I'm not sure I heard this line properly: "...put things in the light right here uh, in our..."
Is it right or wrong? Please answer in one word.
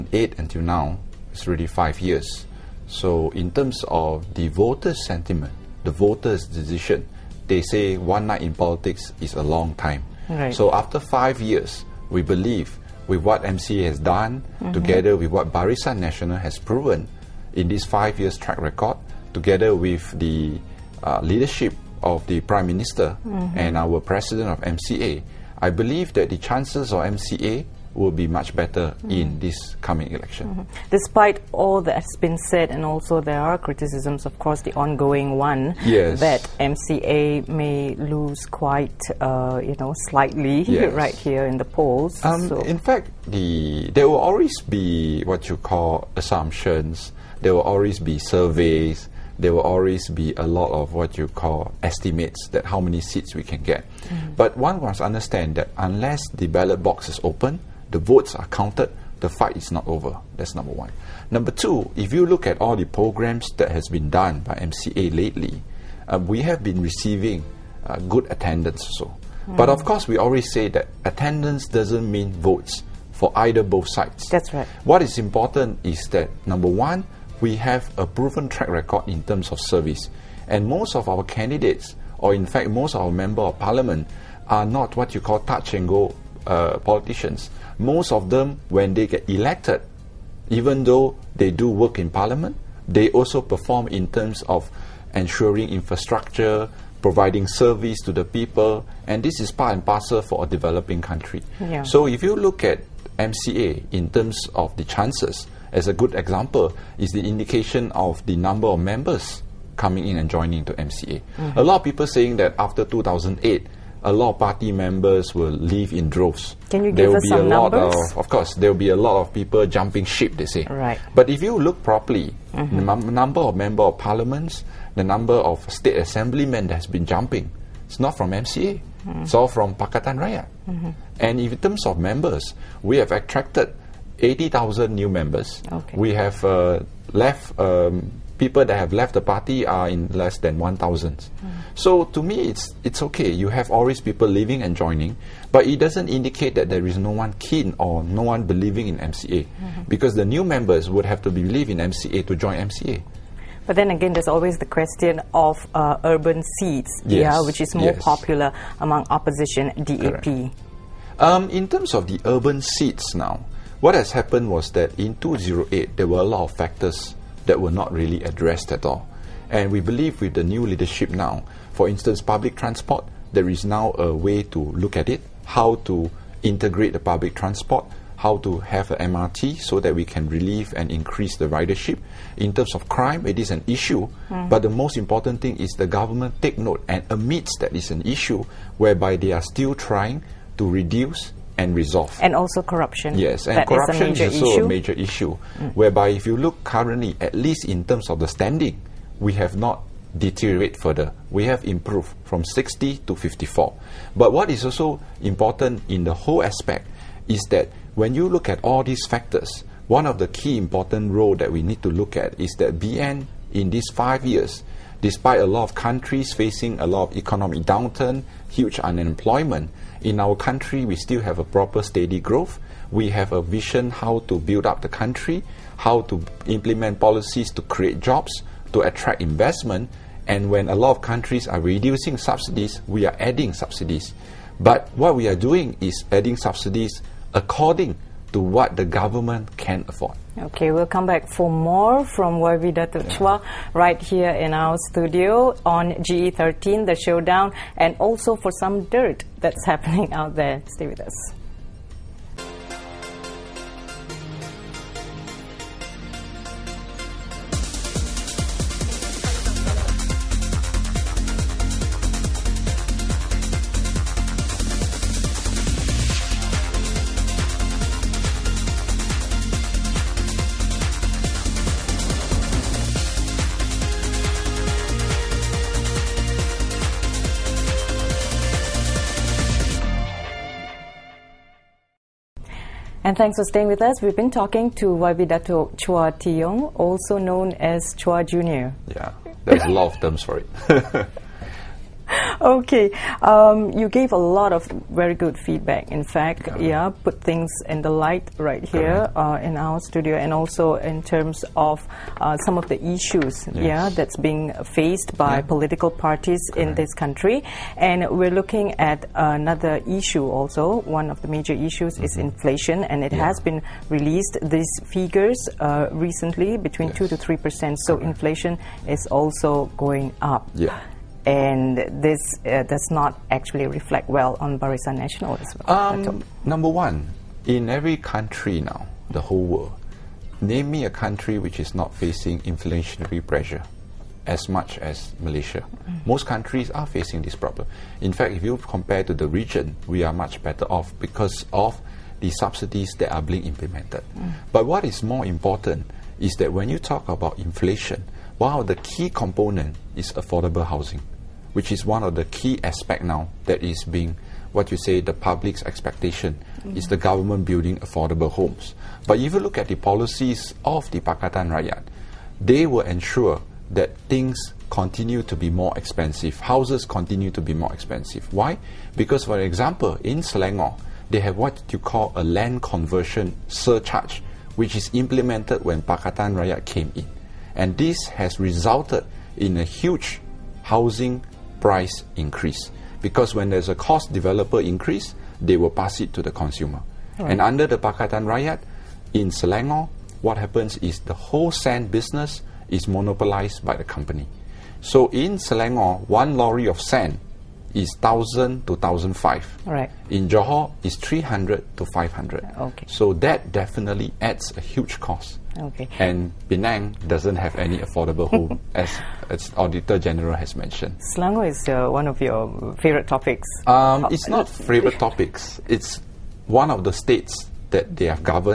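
right.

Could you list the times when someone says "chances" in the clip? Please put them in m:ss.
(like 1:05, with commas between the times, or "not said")
0:26, 1:44.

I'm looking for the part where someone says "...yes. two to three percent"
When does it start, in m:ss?
5:16.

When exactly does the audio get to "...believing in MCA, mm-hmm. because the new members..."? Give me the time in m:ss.
2:28.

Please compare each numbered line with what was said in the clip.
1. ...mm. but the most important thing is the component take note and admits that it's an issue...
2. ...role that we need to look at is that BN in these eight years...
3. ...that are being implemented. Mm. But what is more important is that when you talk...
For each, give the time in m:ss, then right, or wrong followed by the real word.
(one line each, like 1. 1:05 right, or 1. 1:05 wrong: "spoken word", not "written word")
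1. 3:04 wrong: "government", not "component"
2. 3:31 wrong: "five", not "eight"
3. 5:42 right.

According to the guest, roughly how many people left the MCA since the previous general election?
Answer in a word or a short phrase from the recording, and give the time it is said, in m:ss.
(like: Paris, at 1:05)
less than 1,000, at 2:20.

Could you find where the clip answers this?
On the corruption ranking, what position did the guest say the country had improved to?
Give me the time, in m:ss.
3:23.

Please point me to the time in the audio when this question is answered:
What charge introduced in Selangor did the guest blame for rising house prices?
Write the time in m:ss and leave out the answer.
6:12.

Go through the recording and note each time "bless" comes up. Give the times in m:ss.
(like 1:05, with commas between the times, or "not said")
not said.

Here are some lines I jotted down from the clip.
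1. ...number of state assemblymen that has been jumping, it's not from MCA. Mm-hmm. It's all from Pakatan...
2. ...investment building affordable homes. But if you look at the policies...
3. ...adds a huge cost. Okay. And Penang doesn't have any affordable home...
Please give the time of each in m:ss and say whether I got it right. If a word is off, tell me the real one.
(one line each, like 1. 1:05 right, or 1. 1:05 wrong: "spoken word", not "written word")
1. 2:05 right
2. 5:56 wrong: "government", not "investment"
3. 6:44 right.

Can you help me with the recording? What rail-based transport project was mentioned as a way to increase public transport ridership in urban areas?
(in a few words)
MRT.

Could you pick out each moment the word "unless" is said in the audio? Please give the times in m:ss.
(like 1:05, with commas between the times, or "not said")
0:55.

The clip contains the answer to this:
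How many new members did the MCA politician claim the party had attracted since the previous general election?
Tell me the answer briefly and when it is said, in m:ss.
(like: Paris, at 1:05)
80,000, at 2:14.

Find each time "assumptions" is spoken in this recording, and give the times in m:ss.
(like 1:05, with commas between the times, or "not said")
0:46.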